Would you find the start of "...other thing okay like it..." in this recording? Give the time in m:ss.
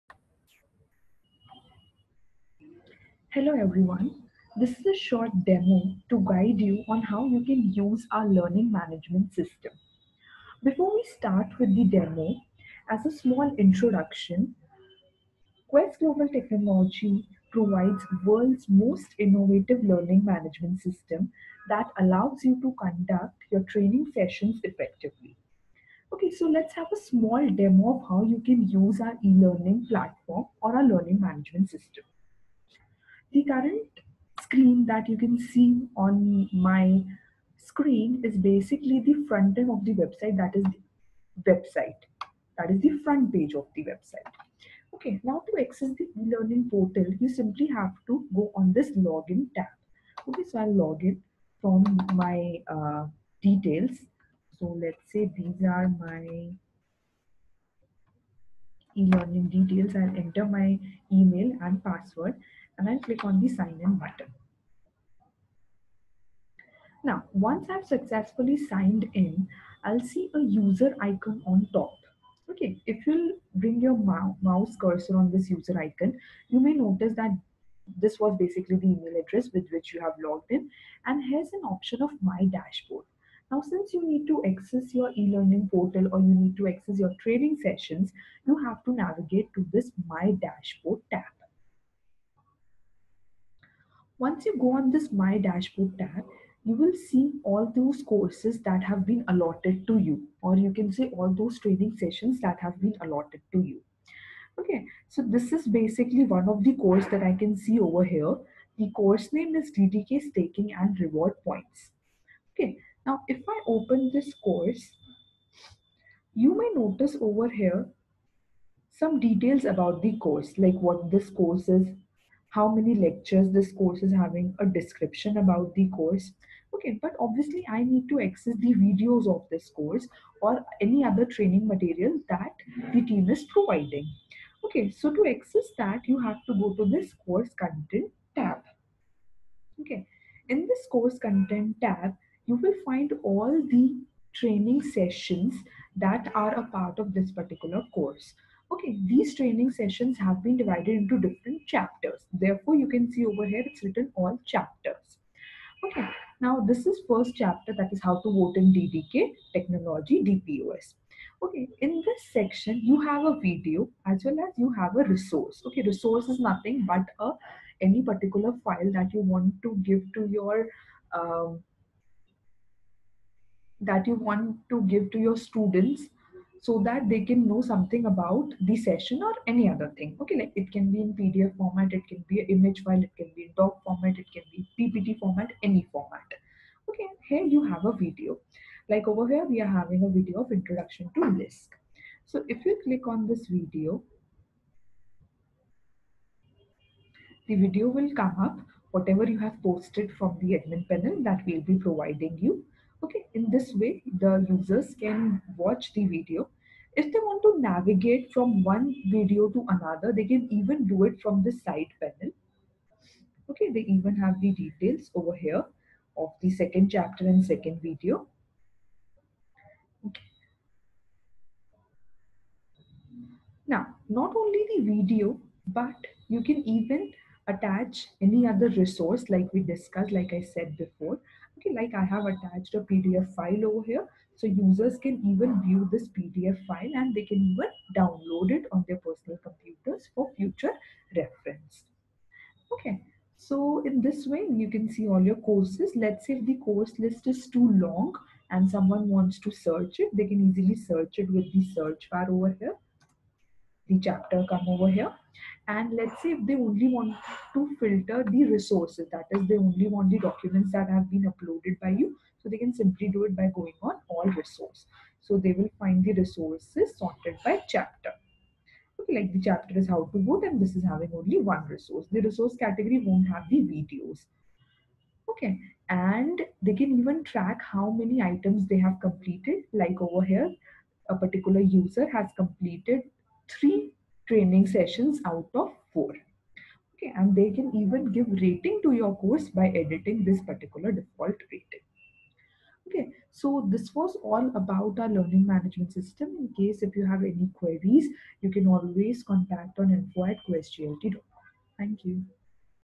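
2:59.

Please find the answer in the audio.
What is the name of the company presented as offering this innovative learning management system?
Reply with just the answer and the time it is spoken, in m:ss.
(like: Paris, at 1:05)
Quest Global Technology, at 0:15.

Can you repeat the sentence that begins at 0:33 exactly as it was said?
The current screen that you can see on my screen is basically the front end of the website, that is the website.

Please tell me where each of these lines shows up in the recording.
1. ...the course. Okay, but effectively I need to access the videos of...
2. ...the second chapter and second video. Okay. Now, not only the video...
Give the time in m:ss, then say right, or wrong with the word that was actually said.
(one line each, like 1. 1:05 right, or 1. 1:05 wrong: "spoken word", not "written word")
1. 2:05 wrong: "obviously", not "effectively"
2. 3:36 right.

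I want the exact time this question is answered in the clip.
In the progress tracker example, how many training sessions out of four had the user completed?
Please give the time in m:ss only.
4:43.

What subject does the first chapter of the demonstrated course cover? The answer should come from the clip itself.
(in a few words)
How to vote in DDK technology DPOS.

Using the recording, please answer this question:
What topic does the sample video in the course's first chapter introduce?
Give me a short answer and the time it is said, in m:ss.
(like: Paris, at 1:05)
Lisk, at 3:11.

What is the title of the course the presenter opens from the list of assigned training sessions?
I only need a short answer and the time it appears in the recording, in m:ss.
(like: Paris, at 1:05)
DDK Staking and Reward Points, at 1:49.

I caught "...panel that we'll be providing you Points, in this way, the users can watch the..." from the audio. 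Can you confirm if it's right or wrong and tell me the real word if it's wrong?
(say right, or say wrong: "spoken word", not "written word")
wrong: "Okay", not "Points".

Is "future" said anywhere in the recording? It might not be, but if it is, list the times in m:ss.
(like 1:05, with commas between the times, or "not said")
4:00.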